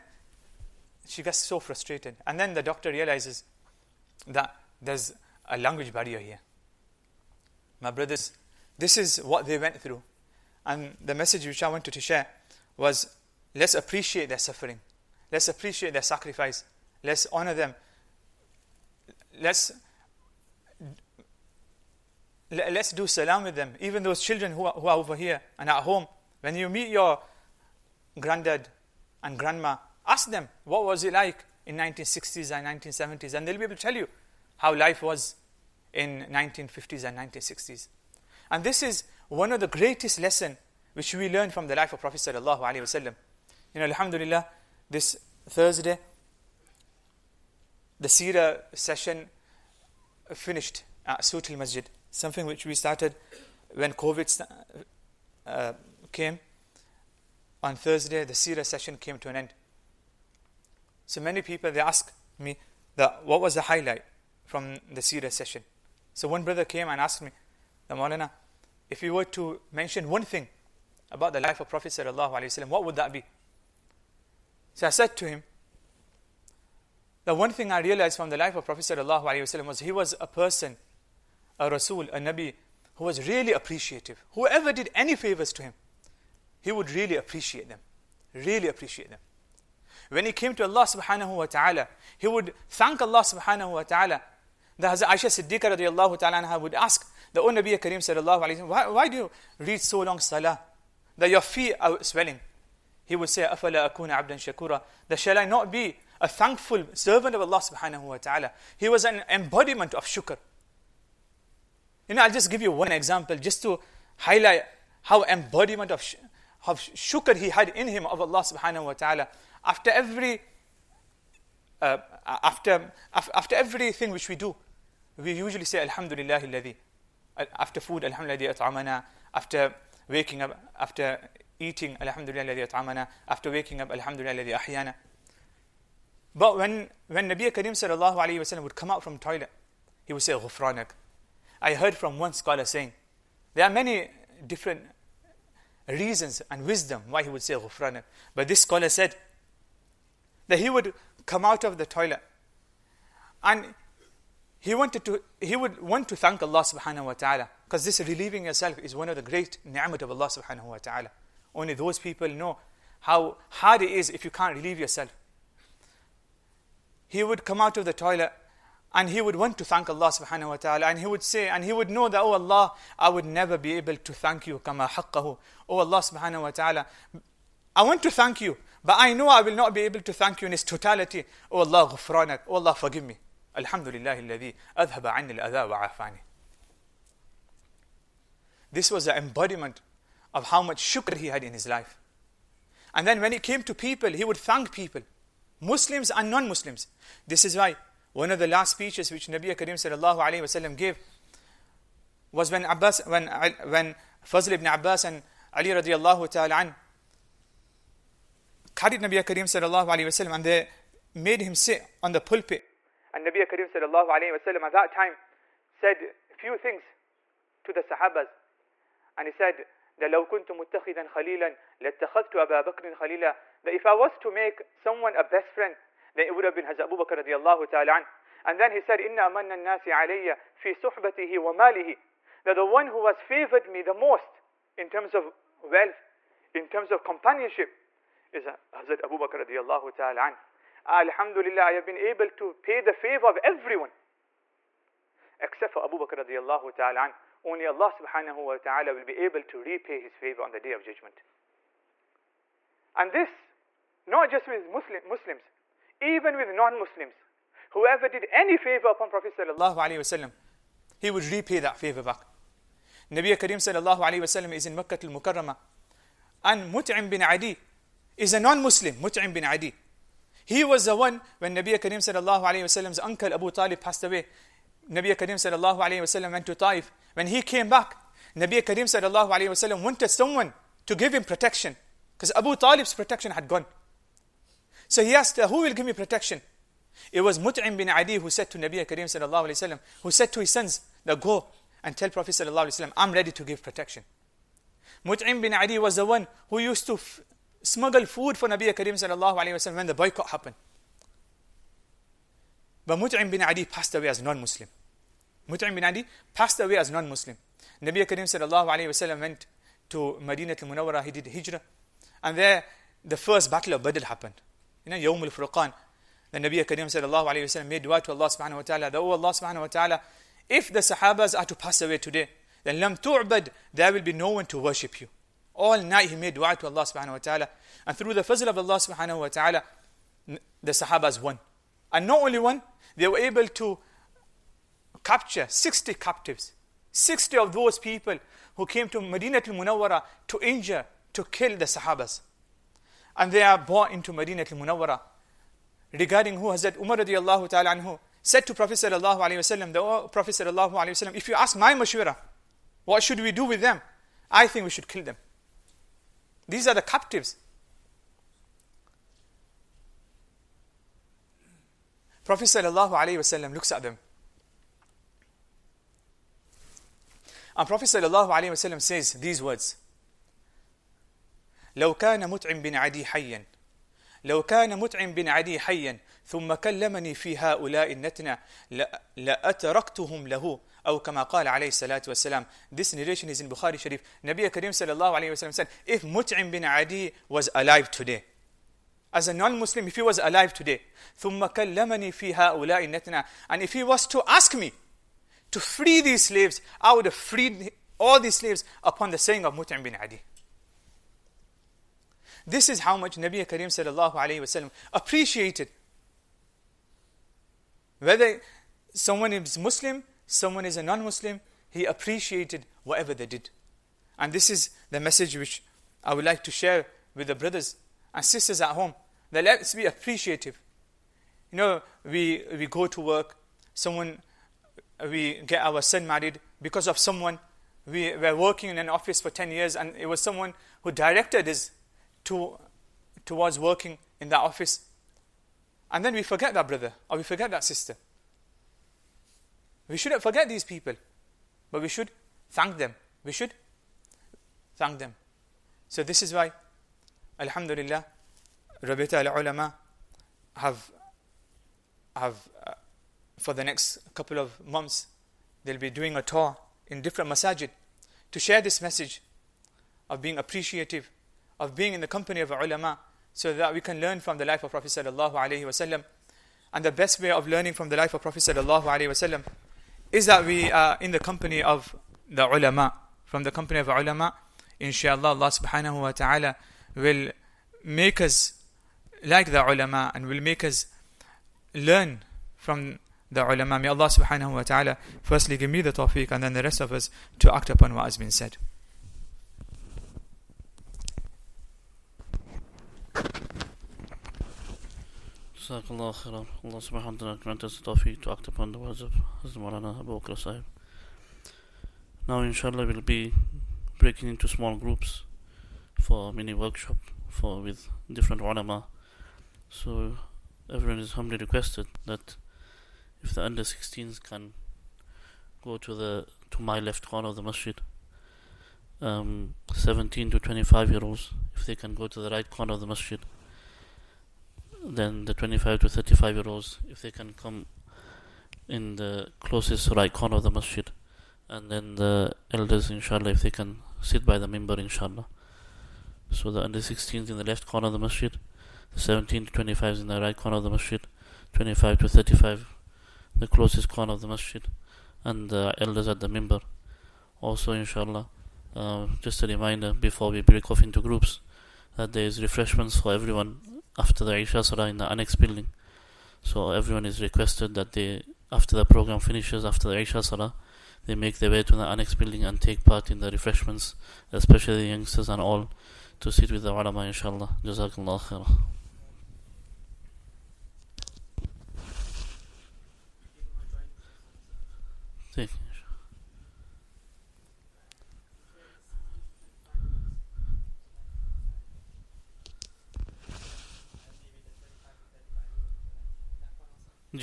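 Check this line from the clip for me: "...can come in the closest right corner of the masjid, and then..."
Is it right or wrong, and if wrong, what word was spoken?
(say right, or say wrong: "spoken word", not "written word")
right.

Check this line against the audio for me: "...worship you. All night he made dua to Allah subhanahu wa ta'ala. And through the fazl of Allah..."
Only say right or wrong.
right.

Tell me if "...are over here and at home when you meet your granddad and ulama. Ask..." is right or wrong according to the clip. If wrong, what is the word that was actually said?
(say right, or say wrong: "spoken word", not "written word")
wrong: "grandma", not "ulama".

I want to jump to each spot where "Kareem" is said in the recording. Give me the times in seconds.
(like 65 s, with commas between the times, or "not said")
97 s.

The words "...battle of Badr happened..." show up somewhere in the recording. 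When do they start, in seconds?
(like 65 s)
313 s.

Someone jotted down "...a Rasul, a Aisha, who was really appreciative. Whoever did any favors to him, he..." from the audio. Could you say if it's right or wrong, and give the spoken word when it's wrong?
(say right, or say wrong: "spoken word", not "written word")
wrong: "Nabi", not "Aisha".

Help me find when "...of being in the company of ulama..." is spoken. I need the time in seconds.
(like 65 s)
461 s.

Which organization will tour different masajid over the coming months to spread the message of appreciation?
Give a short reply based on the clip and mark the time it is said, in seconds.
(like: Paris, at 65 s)
Rabita al-Ulama, at 448 s.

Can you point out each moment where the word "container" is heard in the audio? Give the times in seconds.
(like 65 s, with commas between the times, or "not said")
not said.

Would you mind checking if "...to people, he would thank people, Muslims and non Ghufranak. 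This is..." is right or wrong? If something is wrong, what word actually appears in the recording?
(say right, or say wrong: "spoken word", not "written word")
wrong: "Muslims", not "Ghufranak".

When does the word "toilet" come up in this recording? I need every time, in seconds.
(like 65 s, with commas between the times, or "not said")
139 s, 151 s, 167 s.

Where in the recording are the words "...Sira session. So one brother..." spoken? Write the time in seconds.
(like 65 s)
65 s.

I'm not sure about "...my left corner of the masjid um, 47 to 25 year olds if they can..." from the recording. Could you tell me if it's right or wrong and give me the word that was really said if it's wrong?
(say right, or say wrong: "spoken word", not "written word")
wrong: "17", not "47".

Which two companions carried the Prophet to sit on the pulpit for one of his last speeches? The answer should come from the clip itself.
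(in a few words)
Fazl ibn Abbas and Ali.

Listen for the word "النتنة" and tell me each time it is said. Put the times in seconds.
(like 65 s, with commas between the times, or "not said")
377 s, 392 s.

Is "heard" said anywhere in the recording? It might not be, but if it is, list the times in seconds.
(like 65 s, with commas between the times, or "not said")
141 s.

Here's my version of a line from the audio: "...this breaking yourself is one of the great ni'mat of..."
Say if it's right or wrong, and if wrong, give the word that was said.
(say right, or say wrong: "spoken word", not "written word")
wrong: "relieving", not "breaking".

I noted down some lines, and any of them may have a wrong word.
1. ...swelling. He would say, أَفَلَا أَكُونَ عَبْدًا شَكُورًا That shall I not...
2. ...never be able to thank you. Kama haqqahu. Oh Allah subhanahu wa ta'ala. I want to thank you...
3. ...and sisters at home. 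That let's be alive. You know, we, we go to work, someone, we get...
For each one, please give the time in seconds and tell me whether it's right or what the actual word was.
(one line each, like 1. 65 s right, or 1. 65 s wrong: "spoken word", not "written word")
1. 102 s right
2. 173 s right
3. 418 s wrong: "appreciative", not "alive".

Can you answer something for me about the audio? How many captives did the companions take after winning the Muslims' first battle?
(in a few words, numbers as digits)
60.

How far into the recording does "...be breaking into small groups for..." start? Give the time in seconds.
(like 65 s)
503 s.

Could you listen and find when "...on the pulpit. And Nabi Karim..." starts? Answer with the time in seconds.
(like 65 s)
212 s.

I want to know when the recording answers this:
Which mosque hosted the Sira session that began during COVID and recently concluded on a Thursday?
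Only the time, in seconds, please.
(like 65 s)
51 s.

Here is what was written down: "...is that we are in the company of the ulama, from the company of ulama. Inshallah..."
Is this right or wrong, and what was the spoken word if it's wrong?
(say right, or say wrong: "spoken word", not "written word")
right.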